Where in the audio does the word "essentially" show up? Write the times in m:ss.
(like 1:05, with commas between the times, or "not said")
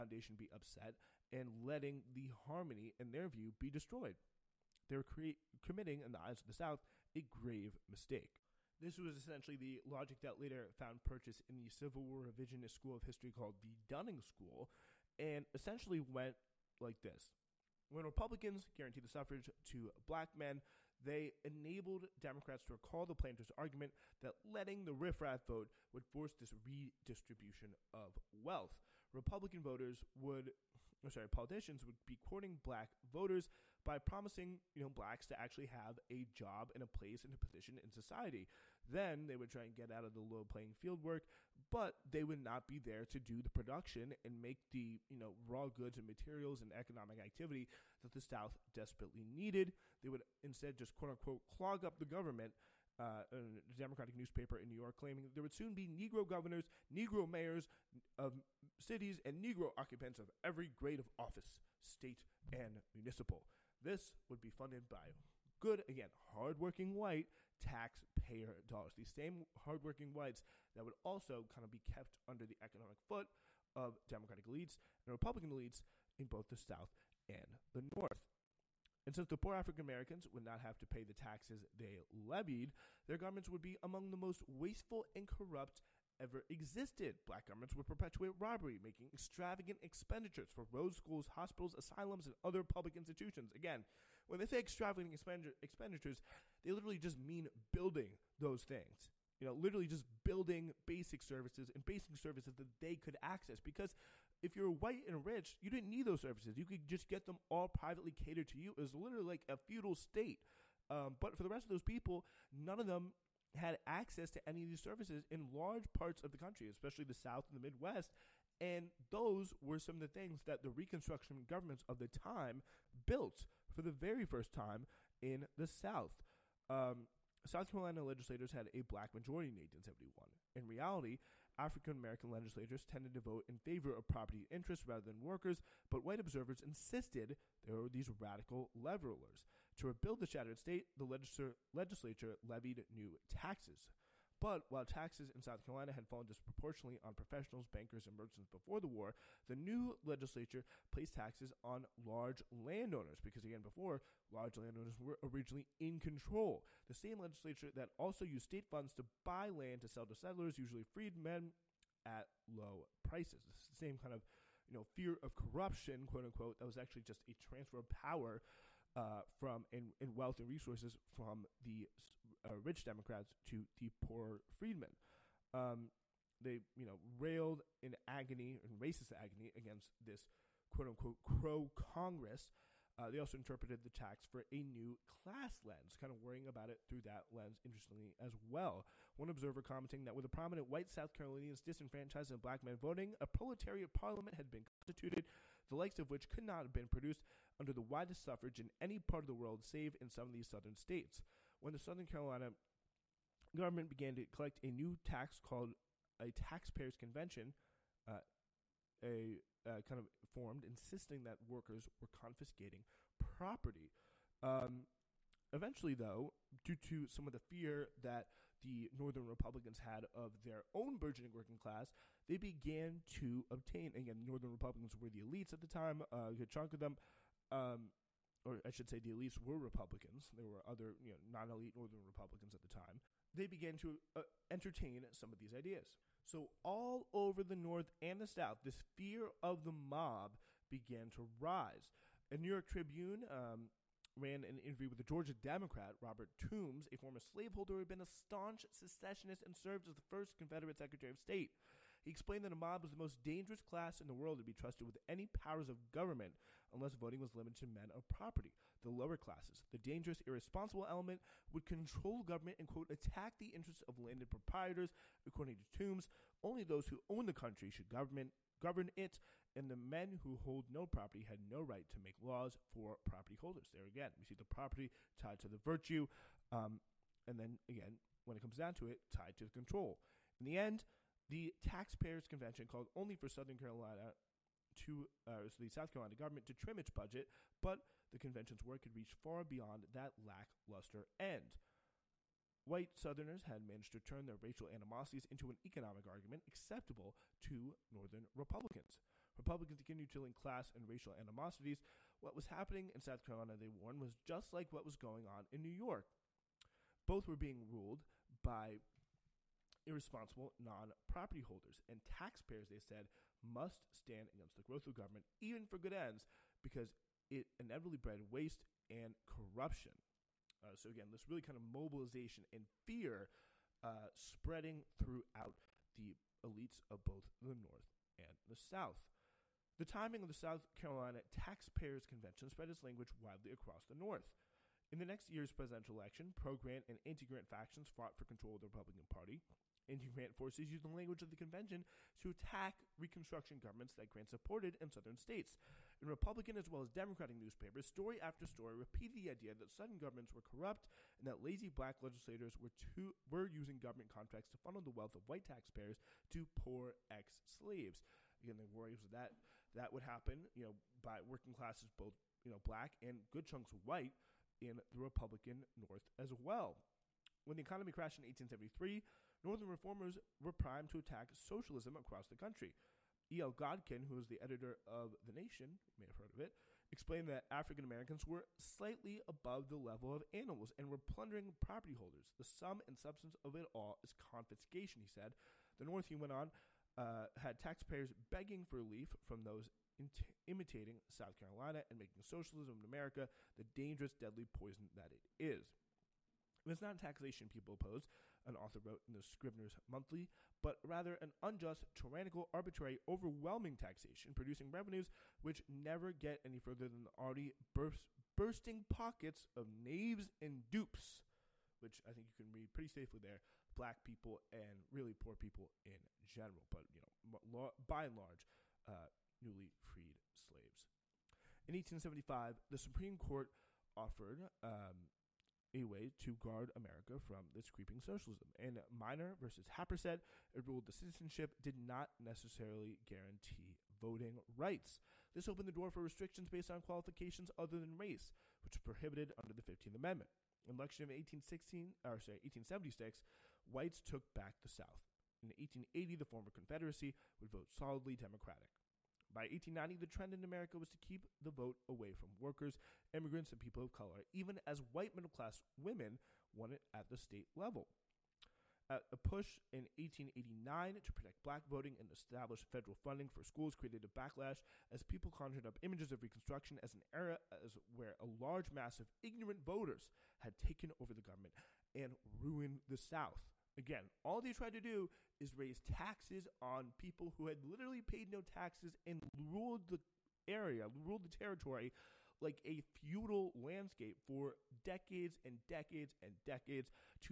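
0:09, 0:15.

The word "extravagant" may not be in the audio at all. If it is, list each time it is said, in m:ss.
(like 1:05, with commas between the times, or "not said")
1:29, 1:34.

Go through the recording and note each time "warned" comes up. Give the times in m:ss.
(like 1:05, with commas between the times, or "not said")
5:03.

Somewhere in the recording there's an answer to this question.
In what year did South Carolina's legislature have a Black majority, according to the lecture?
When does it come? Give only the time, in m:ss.
2:09.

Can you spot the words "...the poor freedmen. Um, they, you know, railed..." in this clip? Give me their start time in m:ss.
2:53.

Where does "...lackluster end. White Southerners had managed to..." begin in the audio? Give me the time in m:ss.
4:50.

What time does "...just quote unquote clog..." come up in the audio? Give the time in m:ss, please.
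0:50.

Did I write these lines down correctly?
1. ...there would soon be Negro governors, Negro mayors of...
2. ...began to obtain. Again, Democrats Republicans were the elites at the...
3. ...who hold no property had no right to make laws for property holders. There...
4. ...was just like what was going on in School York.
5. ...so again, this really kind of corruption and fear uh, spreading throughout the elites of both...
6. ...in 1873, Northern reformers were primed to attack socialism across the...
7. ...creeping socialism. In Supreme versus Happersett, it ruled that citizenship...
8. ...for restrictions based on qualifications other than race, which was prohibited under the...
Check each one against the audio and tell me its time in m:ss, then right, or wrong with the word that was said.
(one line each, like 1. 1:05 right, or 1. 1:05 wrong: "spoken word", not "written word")
1. 0:55 right
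2. 3:42 wrong: "Northern", not "Democrats"
3. 4:30 right
4. 5:04 wrong: "New", not "School"
5. 5:20 wrong: "mobilization", not "corruption"
6. 6:08 right
7. 7:07 wrong: "Minor", not "Supreme"
8. 7:15 right.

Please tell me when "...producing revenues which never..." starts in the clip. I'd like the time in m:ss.
6:44.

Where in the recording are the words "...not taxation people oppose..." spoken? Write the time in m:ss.
6:36.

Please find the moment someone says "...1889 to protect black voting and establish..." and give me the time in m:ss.
7:39.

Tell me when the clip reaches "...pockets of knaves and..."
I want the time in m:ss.
6:48.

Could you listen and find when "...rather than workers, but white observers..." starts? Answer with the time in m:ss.
2:14.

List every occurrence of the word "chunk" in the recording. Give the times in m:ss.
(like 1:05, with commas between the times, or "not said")
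3:46, 6:03.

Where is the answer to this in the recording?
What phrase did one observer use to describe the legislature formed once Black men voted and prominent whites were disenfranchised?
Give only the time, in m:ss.
3:13.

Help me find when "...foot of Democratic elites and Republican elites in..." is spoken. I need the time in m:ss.
1:13.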